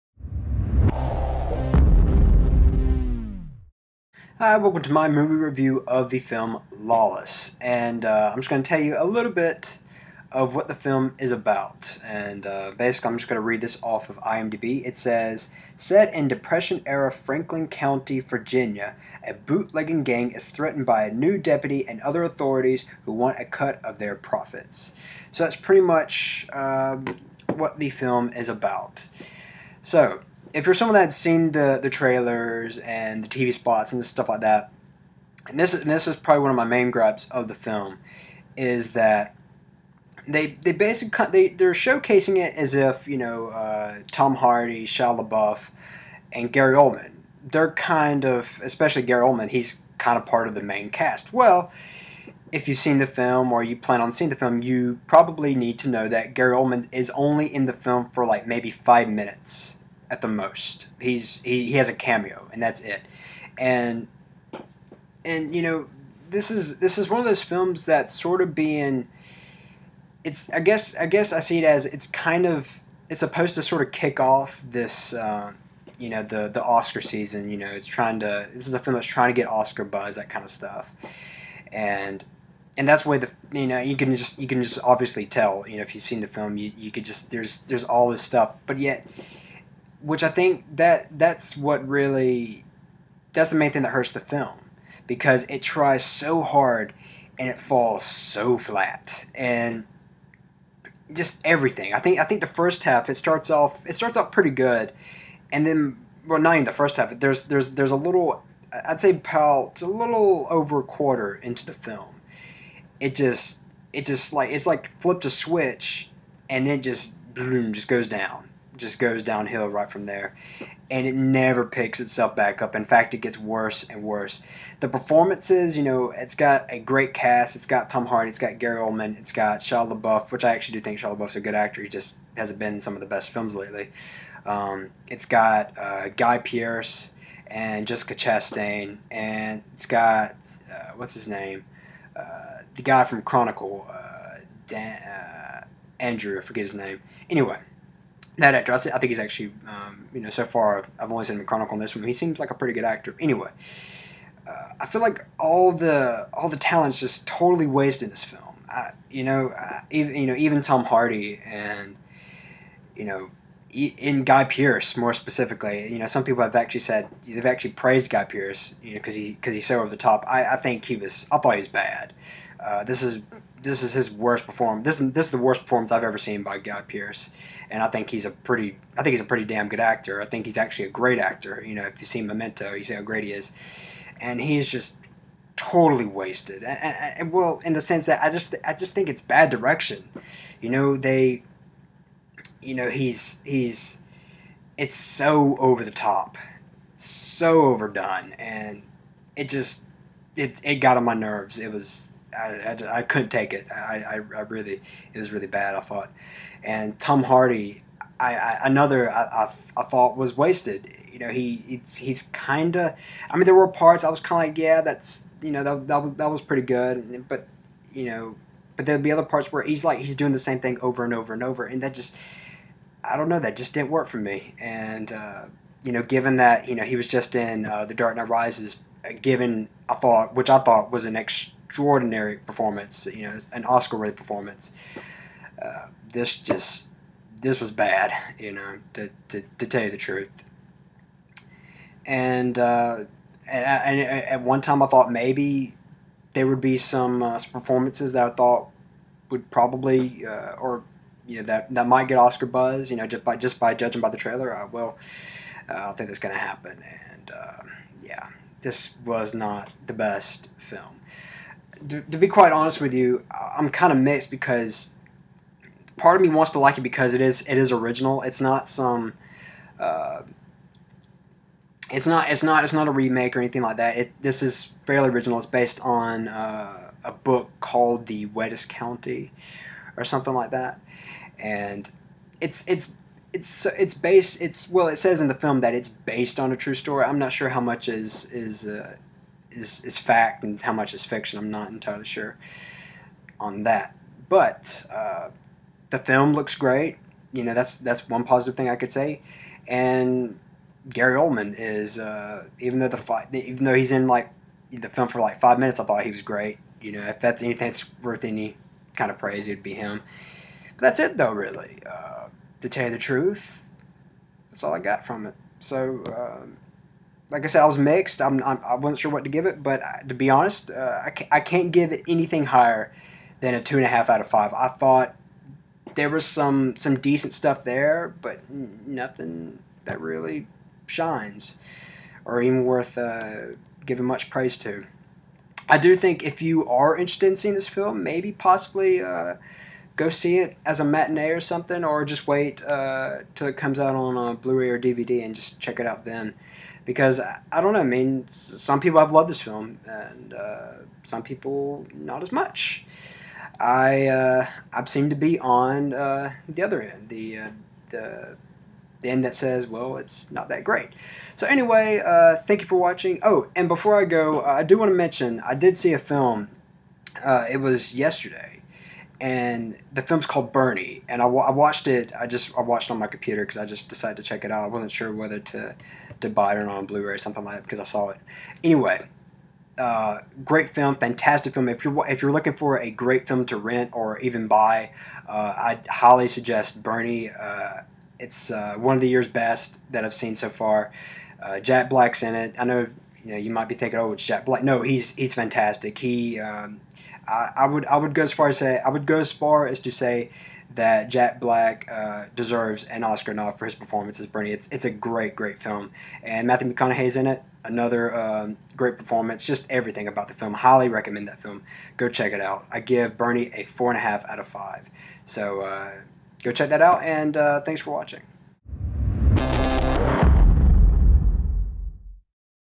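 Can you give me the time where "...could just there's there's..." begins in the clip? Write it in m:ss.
1:26.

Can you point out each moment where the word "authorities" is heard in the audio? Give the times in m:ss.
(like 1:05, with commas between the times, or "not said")
0:22.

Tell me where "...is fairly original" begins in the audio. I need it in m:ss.
4:34.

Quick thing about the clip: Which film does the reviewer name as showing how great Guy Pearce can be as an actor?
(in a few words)
Memento.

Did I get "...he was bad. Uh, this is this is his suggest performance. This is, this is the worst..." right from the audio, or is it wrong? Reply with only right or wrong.
wrong.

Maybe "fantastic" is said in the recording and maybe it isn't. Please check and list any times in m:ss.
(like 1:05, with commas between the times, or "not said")
6:20, 6:35.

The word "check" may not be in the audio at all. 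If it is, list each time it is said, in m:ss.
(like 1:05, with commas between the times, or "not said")
5:45, 6:14, 6:52, 6:56.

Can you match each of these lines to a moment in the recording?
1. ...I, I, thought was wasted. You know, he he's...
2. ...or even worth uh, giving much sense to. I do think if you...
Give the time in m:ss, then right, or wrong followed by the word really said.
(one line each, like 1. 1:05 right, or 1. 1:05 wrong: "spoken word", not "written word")
1. 3:29 right
2. 5:32 wrong: "praise", not "sense".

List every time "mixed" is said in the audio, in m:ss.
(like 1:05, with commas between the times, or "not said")
4:23, 5:17.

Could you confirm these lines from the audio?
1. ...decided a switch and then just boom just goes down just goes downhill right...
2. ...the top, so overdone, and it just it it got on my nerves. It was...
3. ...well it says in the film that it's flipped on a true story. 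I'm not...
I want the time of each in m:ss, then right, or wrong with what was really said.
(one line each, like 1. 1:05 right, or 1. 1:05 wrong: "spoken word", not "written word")
1. 1:54 wrong: "flipped", not "decided"
2. 3:15 right
3. 4:44 wrong: "based", not "flipped".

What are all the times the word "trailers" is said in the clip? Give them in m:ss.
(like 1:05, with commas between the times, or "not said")
0:31, 4:14.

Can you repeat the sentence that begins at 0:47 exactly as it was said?
They're kind of especially Gary Oldman.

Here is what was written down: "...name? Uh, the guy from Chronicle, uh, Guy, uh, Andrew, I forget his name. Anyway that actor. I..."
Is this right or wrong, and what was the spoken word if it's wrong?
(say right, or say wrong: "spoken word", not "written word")
wrong: "Dan", not "Guy".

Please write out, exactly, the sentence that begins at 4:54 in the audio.
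But uh, the film looks great.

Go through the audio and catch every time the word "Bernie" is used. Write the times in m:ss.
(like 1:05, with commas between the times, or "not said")
6:10, 6:26, 6:44, 6:53.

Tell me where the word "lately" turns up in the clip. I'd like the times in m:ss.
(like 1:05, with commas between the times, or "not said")
2:13.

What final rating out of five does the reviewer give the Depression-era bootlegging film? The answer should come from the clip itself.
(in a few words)
2.5.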